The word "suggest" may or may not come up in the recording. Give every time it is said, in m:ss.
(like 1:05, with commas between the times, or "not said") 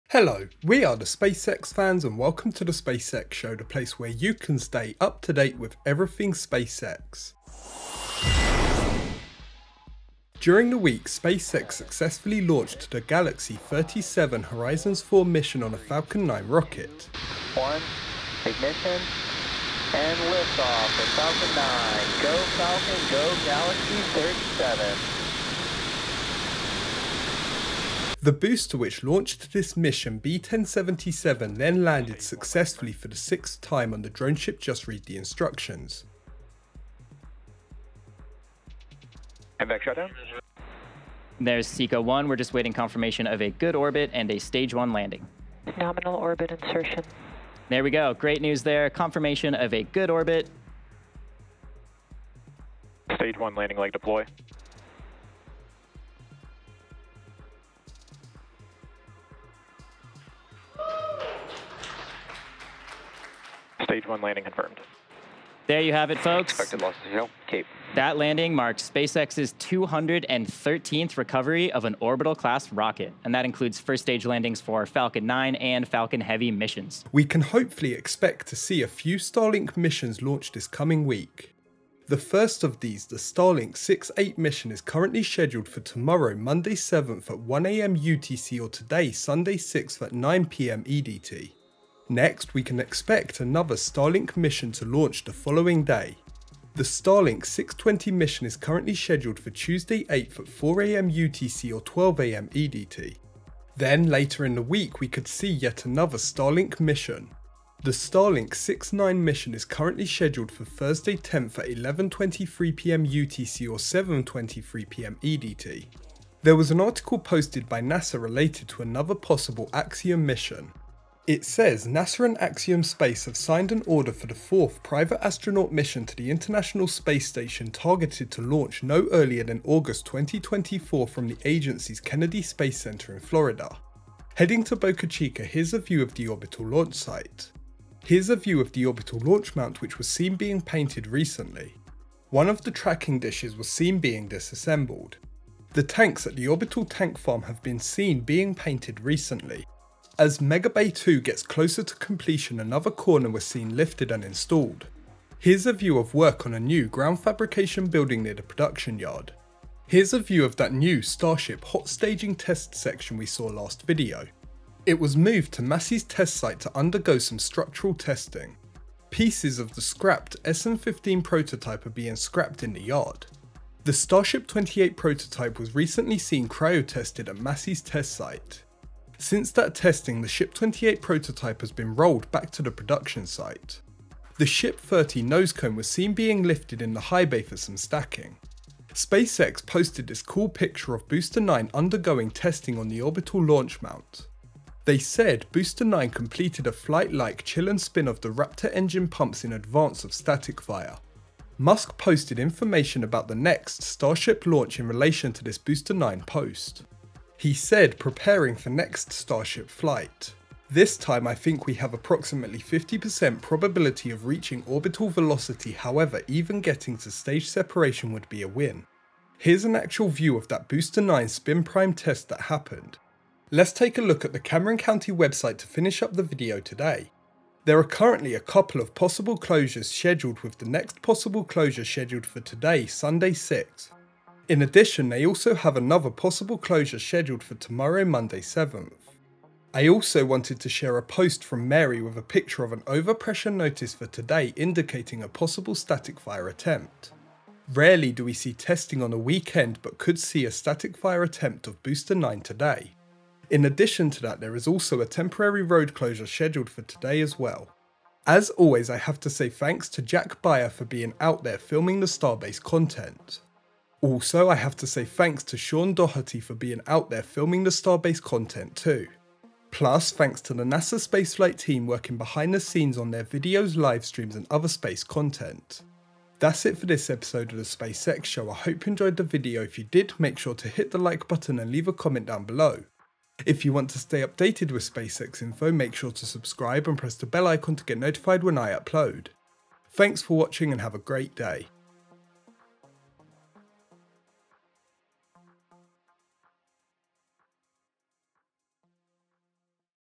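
not said.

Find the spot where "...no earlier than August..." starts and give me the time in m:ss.
2:08.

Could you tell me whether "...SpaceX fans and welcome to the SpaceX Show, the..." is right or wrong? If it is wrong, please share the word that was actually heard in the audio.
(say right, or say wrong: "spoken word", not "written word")
right.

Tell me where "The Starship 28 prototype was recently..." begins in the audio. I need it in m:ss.
2:53.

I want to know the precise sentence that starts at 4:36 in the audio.
That's it for this episode of the SpaceX Show.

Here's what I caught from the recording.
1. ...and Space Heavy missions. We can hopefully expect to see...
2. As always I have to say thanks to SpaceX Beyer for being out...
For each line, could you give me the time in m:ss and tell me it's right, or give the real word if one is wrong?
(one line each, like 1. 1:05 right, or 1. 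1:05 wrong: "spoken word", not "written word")
1. 1:15 wrong: "Falcon", not "Space"
2. 4:18 wrong: "Jack", not "SpaceX".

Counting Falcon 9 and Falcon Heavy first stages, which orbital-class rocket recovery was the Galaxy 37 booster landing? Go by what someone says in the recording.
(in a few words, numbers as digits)
213th.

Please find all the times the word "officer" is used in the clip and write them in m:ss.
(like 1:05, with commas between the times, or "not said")
not said.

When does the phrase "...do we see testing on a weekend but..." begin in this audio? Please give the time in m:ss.
4:08.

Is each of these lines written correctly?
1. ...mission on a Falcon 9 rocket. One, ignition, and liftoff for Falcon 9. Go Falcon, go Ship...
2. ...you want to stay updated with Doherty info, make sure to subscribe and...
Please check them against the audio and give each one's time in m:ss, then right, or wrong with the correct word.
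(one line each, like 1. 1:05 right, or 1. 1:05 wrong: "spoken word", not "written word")
1. 0:15 wrong: "Galaxy", not "Ship"
2. 4:43 wrong: "SpaceX", not "Doherty".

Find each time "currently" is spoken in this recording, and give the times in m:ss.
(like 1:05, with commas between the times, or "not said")
1:24, 1:38, 1:49, 3:47.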